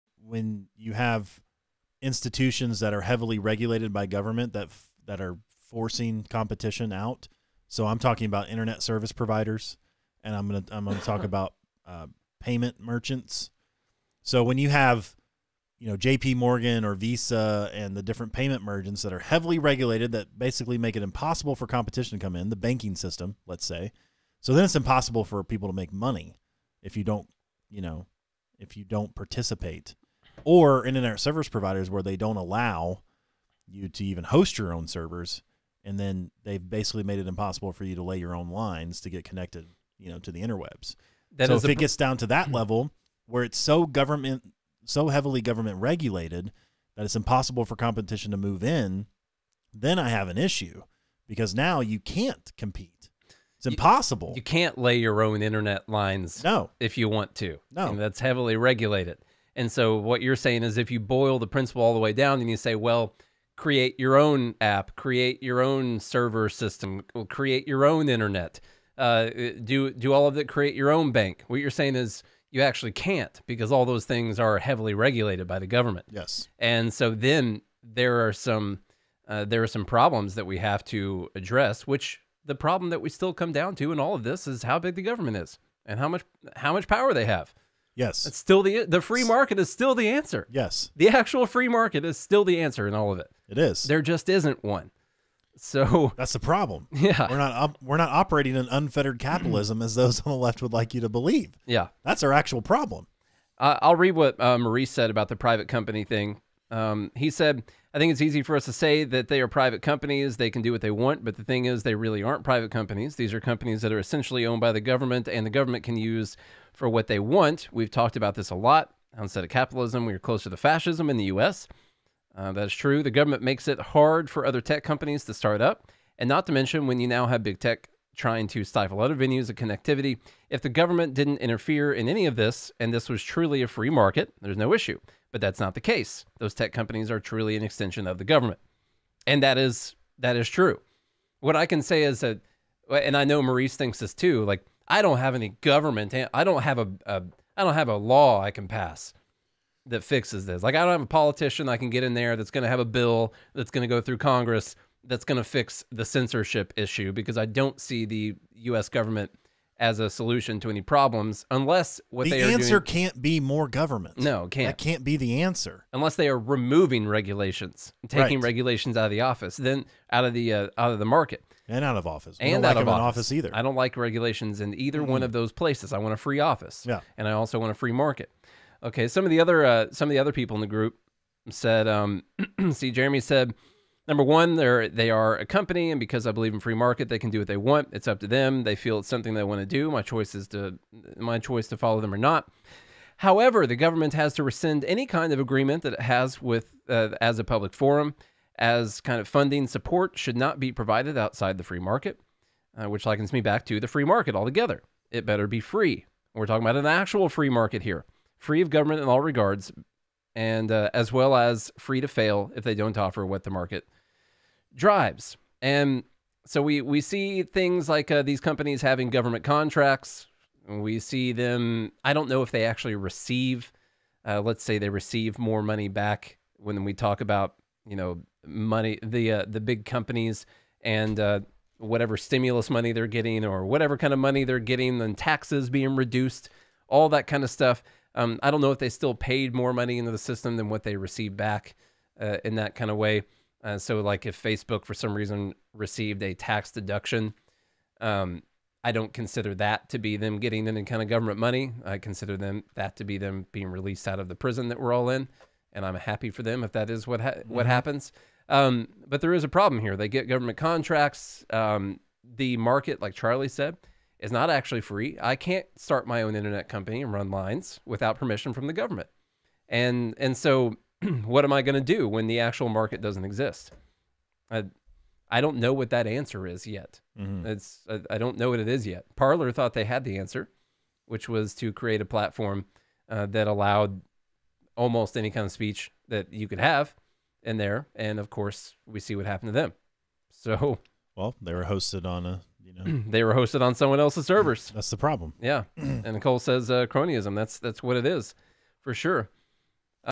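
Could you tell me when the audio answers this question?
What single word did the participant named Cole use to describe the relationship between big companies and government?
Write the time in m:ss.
4:56.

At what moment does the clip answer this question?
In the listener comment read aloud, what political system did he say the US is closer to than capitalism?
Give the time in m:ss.
2:00.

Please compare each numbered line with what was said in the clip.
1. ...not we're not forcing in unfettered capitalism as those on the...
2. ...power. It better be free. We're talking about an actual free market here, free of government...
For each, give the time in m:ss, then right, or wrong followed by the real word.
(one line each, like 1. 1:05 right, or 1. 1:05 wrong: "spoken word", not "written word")
1. 1:37 wrong: "operating", not "forcing"
2. 3:24 wrong: "altogether", not "power".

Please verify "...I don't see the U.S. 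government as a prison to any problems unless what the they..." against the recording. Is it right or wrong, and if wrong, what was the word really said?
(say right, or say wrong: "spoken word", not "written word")
wrong: "solution", not "prison".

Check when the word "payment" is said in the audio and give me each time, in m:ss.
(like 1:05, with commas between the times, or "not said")
0:12, 0:18.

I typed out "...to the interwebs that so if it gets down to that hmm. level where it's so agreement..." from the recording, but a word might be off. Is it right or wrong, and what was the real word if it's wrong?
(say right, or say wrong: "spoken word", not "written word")
wrong: "government", not "agreement".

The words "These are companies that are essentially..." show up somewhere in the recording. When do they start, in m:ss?
1:53.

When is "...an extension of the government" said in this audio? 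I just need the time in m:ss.
2:17.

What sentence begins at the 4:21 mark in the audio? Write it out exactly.
Um, the market, like Charlie said, is not actually free.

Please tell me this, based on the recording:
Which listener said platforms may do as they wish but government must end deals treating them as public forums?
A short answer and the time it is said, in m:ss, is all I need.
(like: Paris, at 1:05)
Jeremy, at 3:02.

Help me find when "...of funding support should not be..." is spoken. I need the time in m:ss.
3:19.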